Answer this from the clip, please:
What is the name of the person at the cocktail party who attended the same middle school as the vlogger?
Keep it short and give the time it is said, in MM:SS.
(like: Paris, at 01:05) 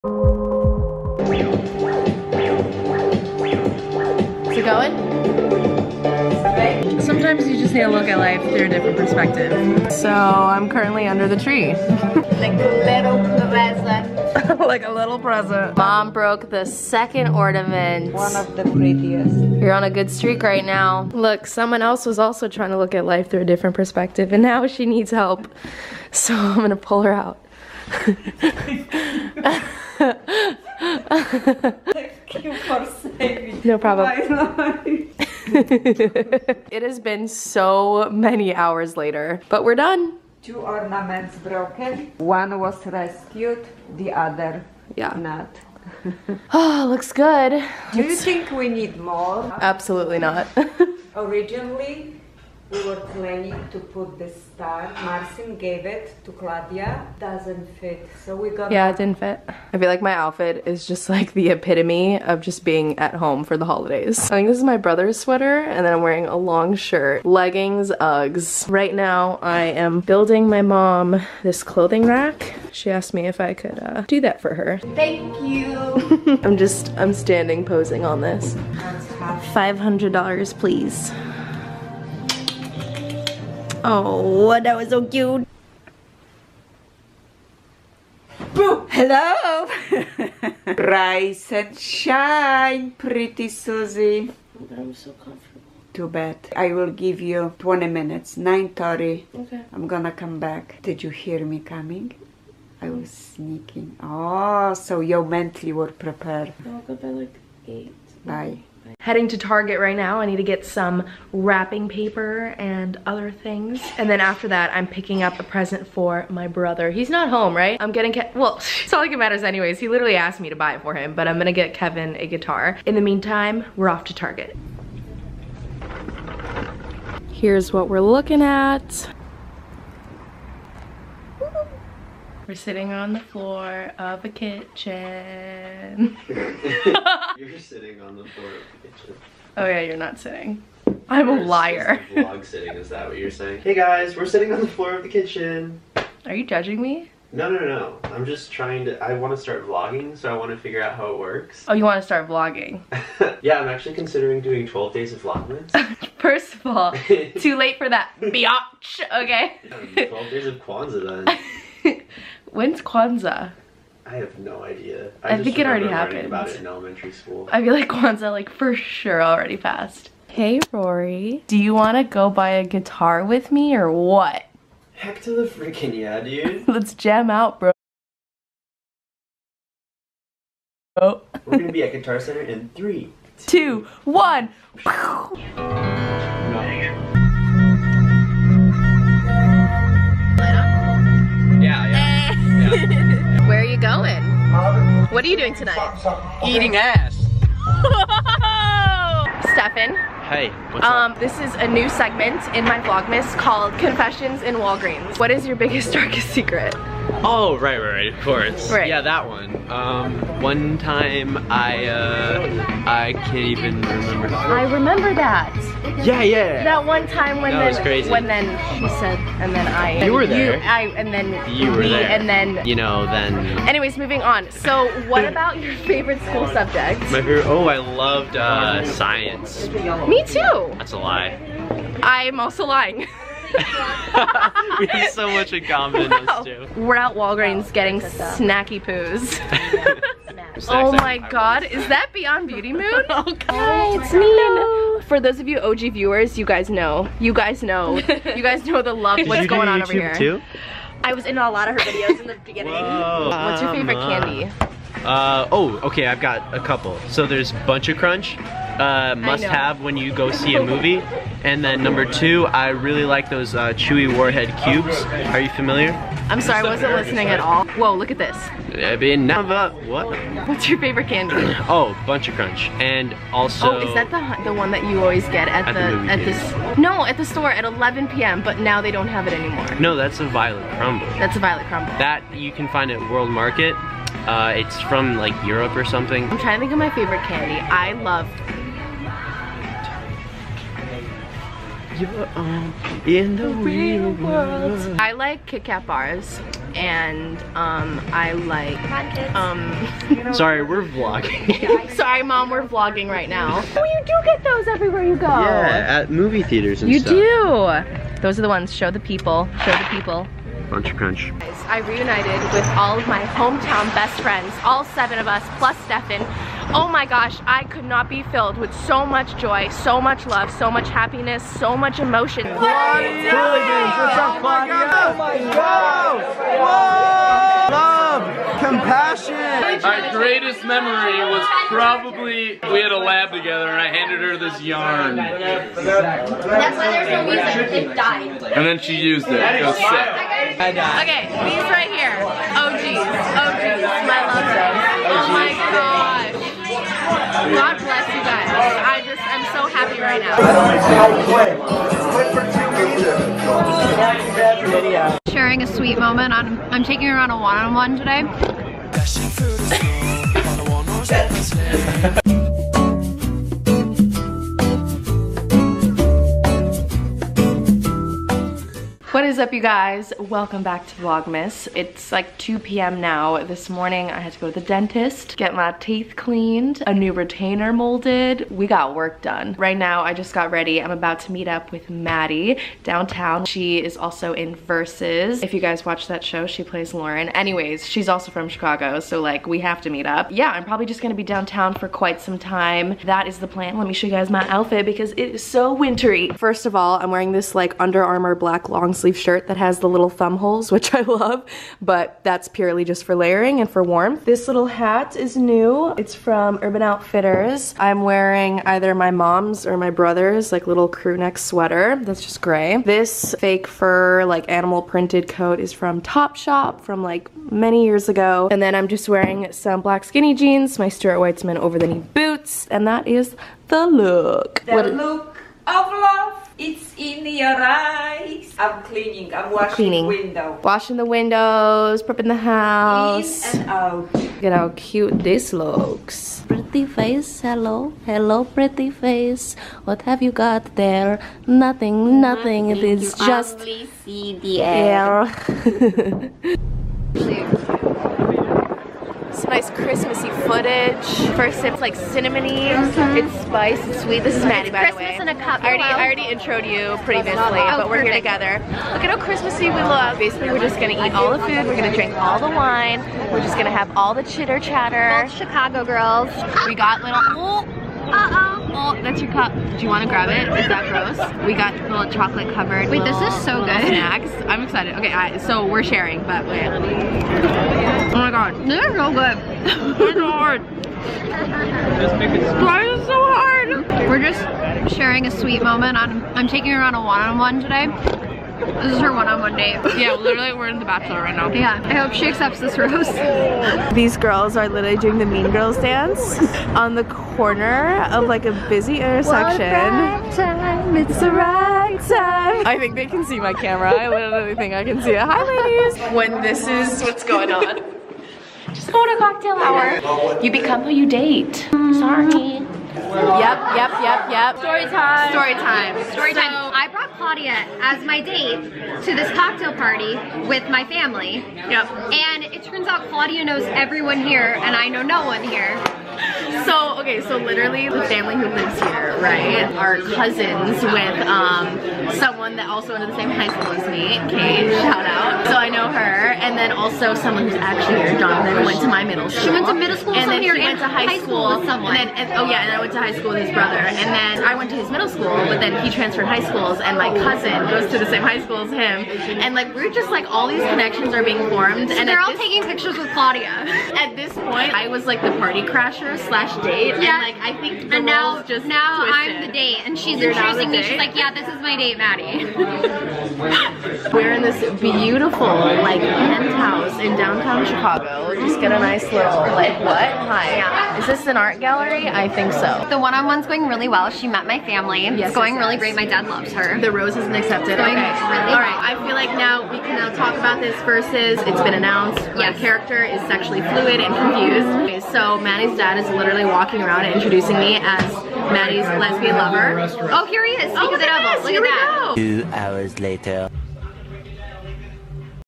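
Jonathan, at 08:58.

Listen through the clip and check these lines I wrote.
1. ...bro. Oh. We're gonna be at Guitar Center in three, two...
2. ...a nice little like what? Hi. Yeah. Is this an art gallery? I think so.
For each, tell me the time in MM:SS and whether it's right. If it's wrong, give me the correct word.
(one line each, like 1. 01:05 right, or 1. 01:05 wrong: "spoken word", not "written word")
1. 02:57 right
2. 09:28 right.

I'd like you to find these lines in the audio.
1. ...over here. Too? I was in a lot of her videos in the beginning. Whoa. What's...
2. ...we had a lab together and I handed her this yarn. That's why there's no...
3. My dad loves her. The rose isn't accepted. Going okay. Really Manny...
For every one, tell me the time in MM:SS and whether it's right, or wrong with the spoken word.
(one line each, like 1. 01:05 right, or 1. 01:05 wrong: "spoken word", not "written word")
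1. 04:09 right
2. 05:32 right
3. 09:35 wrong: "All", not "Manny".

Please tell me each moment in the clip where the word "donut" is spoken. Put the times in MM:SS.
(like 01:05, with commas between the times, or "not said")
not said.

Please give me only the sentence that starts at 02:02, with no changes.
In the meantime, we're off to Target.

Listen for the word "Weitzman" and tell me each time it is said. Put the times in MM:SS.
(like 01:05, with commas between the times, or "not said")
07:01.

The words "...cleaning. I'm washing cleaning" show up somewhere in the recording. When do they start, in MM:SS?
07:08.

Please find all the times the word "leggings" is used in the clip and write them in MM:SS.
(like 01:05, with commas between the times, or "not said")
01:07.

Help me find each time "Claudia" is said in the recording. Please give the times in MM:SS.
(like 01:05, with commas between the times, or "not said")
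00:56, 08:37, 08:43, 09:13.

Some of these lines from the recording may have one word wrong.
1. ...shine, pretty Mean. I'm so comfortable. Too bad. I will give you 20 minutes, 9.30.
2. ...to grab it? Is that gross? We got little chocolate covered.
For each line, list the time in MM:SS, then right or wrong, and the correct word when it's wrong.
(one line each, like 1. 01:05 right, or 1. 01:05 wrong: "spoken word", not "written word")
1. 01:31 wrong: "Susie", not "Mean"
2. 07:50 right.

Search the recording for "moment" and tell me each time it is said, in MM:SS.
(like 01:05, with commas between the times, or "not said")
05:55, 08:05.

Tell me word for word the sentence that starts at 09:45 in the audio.
So Manny's dad is literally walking around and introducing me as Maddie's lesbian lover.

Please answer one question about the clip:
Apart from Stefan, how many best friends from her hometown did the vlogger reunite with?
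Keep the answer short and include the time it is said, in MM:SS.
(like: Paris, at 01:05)
seven, at 05:14.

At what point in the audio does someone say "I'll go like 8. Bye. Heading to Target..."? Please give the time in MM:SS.
01:46.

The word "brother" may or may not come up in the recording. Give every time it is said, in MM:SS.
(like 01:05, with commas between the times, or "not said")
01:04, 01:56, 06:49, 09:03.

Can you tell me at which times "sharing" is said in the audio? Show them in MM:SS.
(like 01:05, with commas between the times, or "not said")
05:55, 07:55, 08:04.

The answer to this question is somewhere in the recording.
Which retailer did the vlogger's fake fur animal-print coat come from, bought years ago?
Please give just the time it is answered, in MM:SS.
06:56.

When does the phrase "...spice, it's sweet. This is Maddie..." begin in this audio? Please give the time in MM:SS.
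07:33.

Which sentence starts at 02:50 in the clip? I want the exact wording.
Hey Rory, do you want to go buy a guitar with me or what?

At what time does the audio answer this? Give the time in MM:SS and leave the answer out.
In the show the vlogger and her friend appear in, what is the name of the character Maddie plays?
06:26.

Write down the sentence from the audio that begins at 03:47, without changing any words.
My favorite, oh, I loved, uh, science.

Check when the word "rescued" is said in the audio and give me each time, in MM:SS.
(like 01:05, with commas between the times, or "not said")
00:42.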